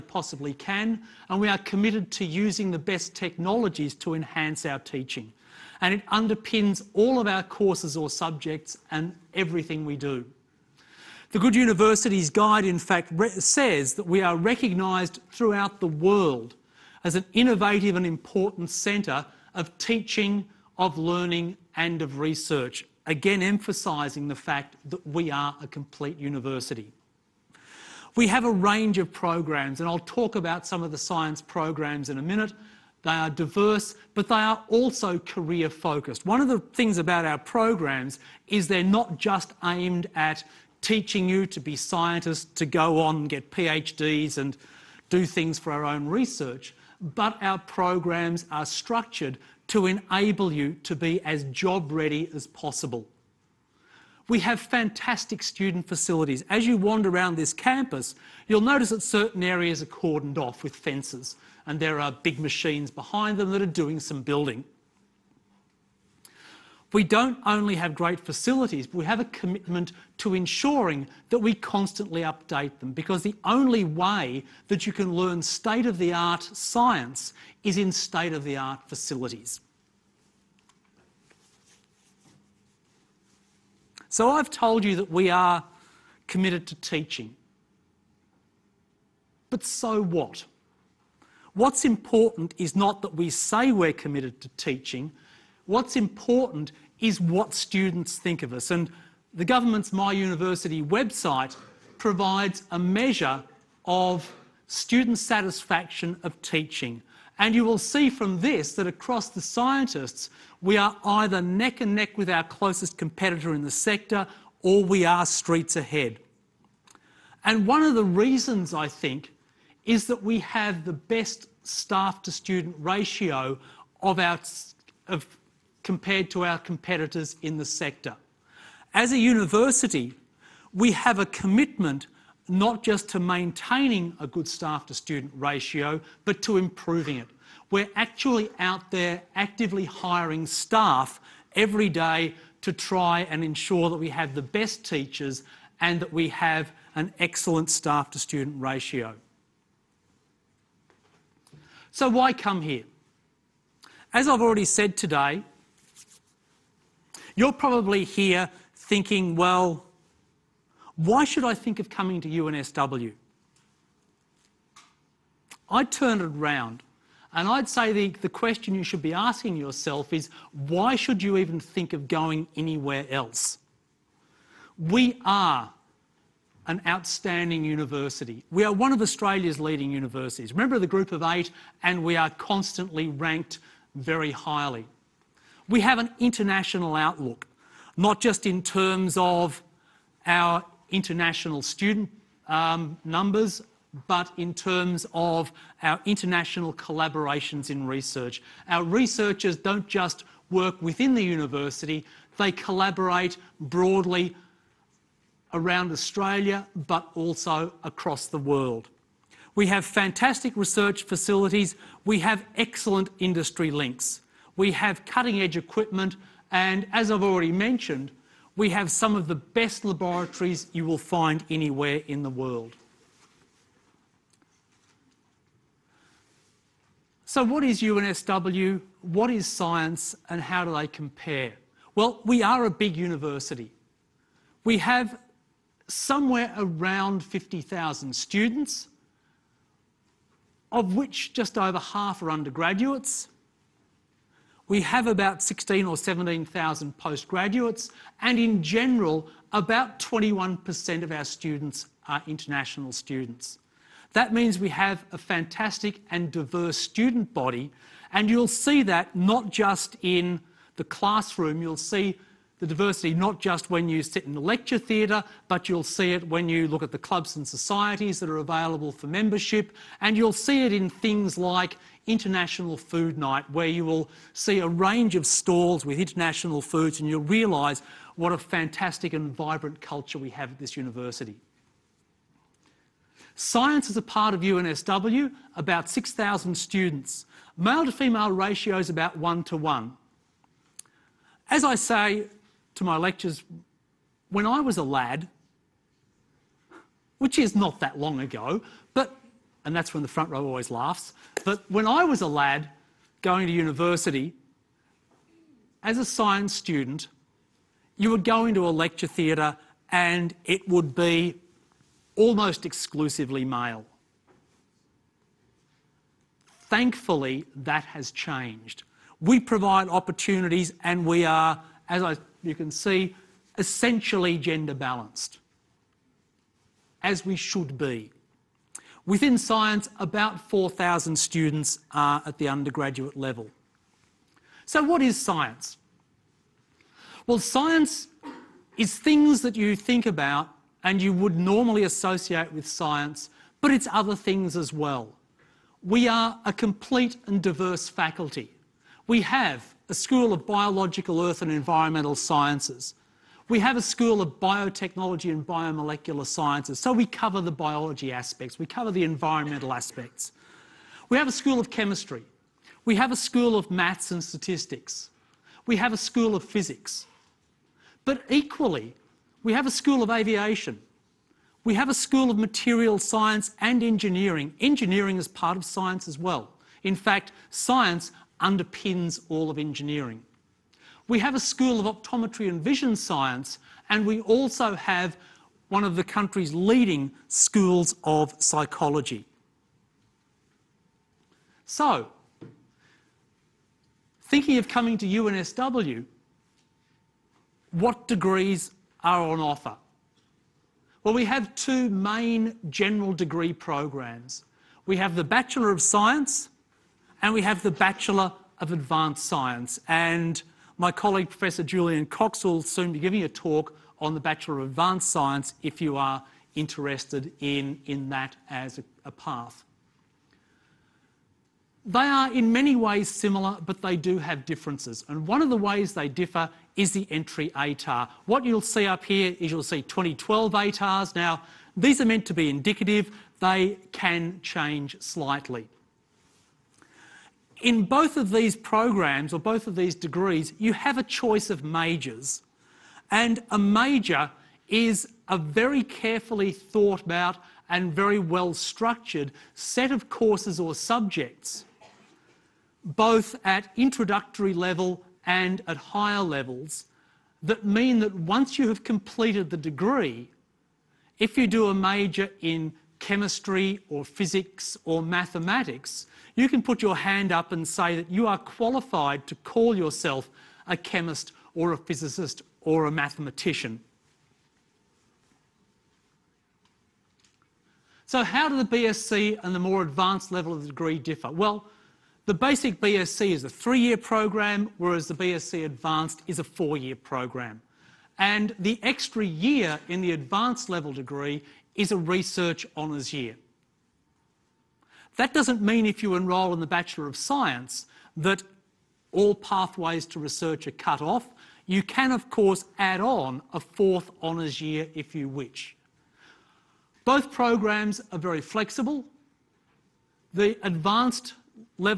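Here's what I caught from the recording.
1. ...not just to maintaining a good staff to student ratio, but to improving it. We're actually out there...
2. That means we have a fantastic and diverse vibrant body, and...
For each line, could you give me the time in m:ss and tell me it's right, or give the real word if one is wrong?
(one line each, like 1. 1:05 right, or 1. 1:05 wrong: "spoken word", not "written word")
1. 2:12 right
2. 4:14 wrong: "student", not "vibrant".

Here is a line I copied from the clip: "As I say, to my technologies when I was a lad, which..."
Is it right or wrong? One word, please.
wrong.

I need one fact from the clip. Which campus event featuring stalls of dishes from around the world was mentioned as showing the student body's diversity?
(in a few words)
International Food Night.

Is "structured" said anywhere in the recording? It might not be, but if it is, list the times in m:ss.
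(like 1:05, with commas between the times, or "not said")
0:48, 7:28.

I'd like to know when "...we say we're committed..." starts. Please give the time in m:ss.
1:33.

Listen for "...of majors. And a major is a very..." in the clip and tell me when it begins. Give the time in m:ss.
7:21.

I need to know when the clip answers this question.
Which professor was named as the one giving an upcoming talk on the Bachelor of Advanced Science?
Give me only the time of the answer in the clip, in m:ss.
6:51.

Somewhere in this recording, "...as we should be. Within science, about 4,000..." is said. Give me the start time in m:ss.
5:27.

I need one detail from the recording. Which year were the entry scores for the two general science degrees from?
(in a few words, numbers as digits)
2012.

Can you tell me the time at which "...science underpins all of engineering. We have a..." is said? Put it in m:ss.
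6:17.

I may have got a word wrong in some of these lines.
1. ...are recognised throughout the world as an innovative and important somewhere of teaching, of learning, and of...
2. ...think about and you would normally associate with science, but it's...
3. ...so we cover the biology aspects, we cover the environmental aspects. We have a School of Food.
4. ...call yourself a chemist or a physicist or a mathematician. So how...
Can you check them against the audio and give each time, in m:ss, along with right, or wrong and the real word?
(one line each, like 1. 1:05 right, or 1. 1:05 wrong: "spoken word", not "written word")
1. 0:14 wrong: "centre", not "somewhere"
2. 5:39 right
3. 5:56 wrong: "Chemistry", not "Food"
4. 7:49 right.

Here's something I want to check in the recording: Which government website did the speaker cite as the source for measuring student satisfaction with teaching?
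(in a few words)
My University.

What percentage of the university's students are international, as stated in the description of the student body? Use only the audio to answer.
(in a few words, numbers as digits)
21%.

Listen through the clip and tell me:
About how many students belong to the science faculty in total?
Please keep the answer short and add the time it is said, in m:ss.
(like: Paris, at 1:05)
6,000, at 4:45.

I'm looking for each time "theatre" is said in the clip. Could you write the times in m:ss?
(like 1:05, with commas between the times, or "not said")
4:24, 5:09.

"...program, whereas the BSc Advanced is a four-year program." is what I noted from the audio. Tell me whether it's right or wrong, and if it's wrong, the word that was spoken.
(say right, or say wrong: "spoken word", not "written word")
right.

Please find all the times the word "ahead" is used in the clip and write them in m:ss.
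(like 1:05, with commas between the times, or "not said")
1:55.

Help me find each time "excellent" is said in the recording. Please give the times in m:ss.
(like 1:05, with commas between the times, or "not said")
2:27, 3:32.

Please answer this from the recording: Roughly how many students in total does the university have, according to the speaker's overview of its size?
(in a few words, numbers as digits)
50,000.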